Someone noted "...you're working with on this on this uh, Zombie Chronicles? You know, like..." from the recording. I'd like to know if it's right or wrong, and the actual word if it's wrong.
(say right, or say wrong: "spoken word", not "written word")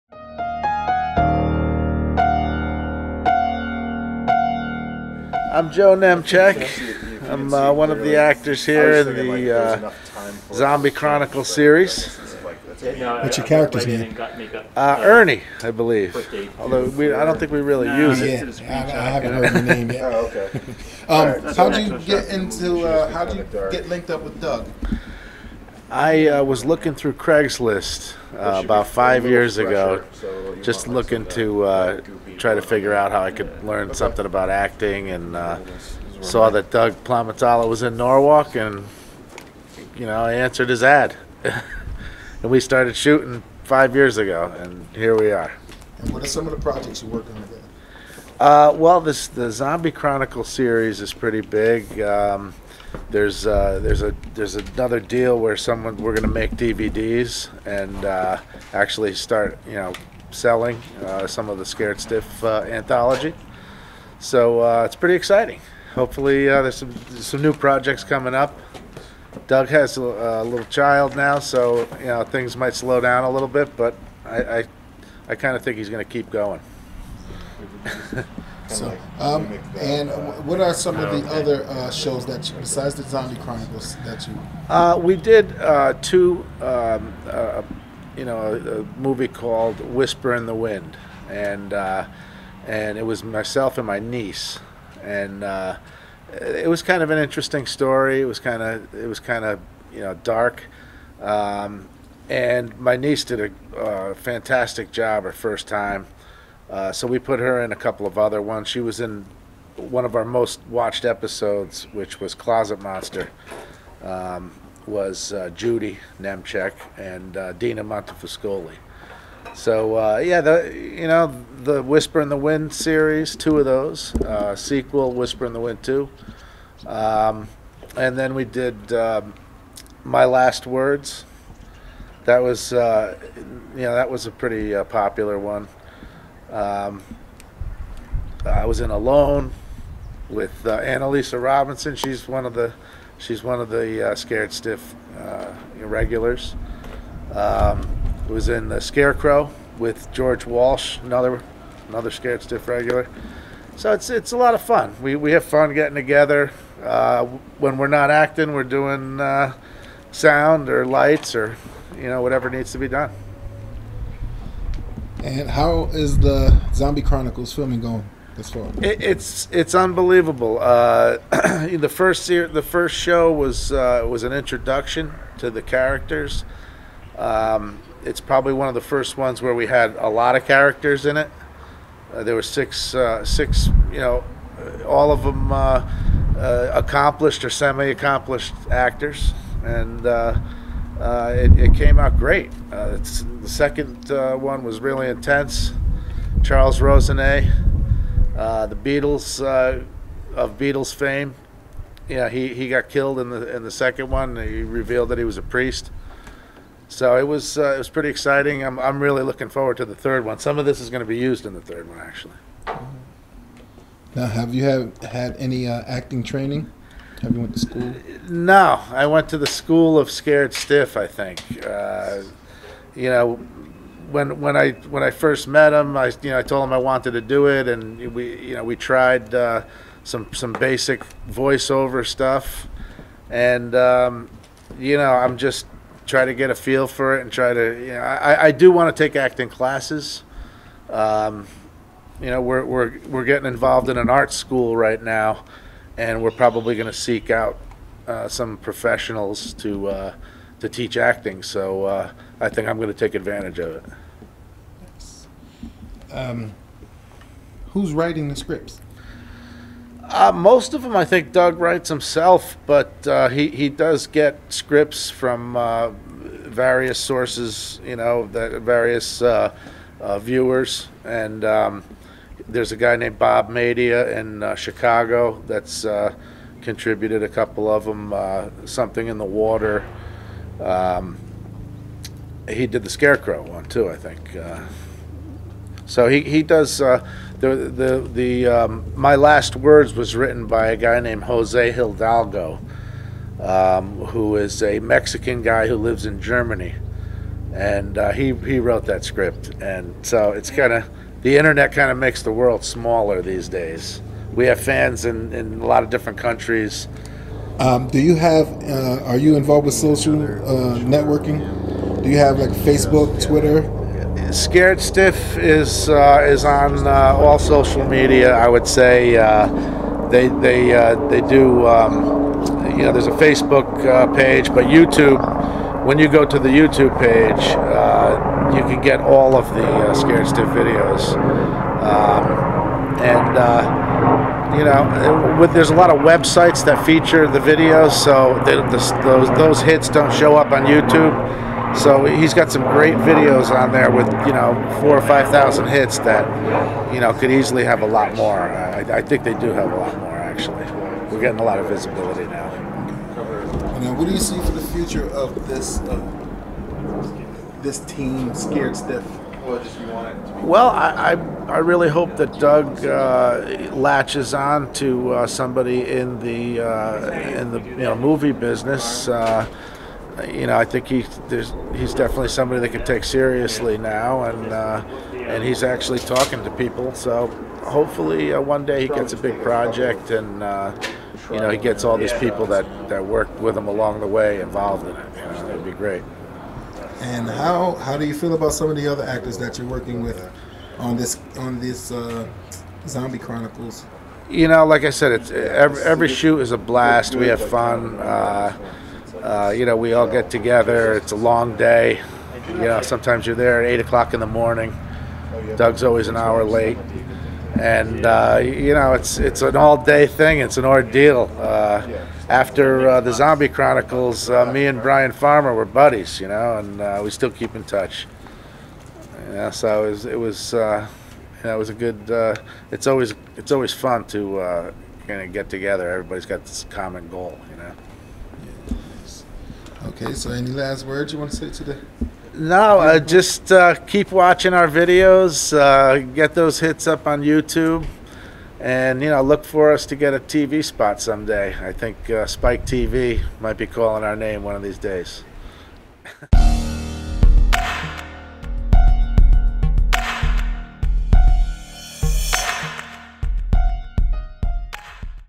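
right.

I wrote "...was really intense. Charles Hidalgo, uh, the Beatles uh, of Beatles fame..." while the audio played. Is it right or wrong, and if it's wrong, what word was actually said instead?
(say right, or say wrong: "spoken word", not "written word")
wrong: "Rosenet", not "Hidalgo".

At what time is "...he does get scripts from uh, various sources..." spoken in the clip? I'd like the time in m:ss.
4:23.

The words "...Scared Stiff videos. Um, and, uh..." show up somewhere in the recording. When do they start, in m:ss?
5:29.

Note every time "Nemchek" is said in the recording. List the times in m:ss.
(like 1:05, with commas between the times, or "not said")
0:05, 1:56.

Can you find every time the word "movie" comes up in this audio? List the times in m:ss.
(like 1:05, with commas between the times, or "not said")
1:28, 6:07.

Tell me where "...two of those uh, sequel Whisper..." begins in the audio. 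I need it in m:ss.
2:03.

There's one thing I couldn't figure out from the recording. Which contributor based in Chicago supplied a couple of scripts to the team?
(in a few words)
Bob Medea.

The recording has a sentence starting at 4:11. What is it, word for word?
So uh, I think I'm going to take advantage of it.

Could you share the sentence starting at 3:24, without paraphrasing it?
He revealed that he was a priest.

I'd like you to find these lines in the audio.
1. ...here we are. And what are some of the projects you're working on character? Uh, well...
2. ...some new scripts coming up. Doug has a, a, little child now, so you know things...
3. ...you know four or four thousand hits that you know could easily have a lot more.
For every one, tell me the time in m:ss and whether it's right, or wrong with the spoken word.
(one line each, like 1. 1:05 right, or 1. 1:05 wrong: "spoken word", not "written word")
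1. 0:44 wrong: "together", not "character"
2. 1:07 wrong: "projects", not "scripts"
3. 5:44 wrong: "five", not "four".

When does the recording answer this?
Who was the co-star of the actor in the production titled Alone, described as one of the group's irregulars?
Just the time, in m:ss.
2:20.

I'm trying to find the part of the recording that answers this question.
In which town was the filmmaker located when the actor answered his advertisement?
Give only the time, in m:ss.
0:37.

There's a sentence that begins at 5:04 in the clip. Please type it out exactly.
We have fans in, in a lot of different countries.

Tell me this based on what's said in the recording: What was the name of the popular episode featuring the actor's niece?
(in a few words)
Closet Monster.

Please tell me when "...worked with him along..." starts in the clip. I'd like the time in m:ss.
6:23.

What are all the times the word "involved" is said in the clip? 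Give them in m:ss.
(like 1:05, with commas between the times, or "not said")
4:03, 5:09, 6:24.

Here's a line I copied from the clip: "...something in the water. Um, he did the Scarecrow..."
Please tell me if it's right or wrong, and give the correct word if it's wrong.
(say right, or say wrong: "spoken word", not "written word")
right.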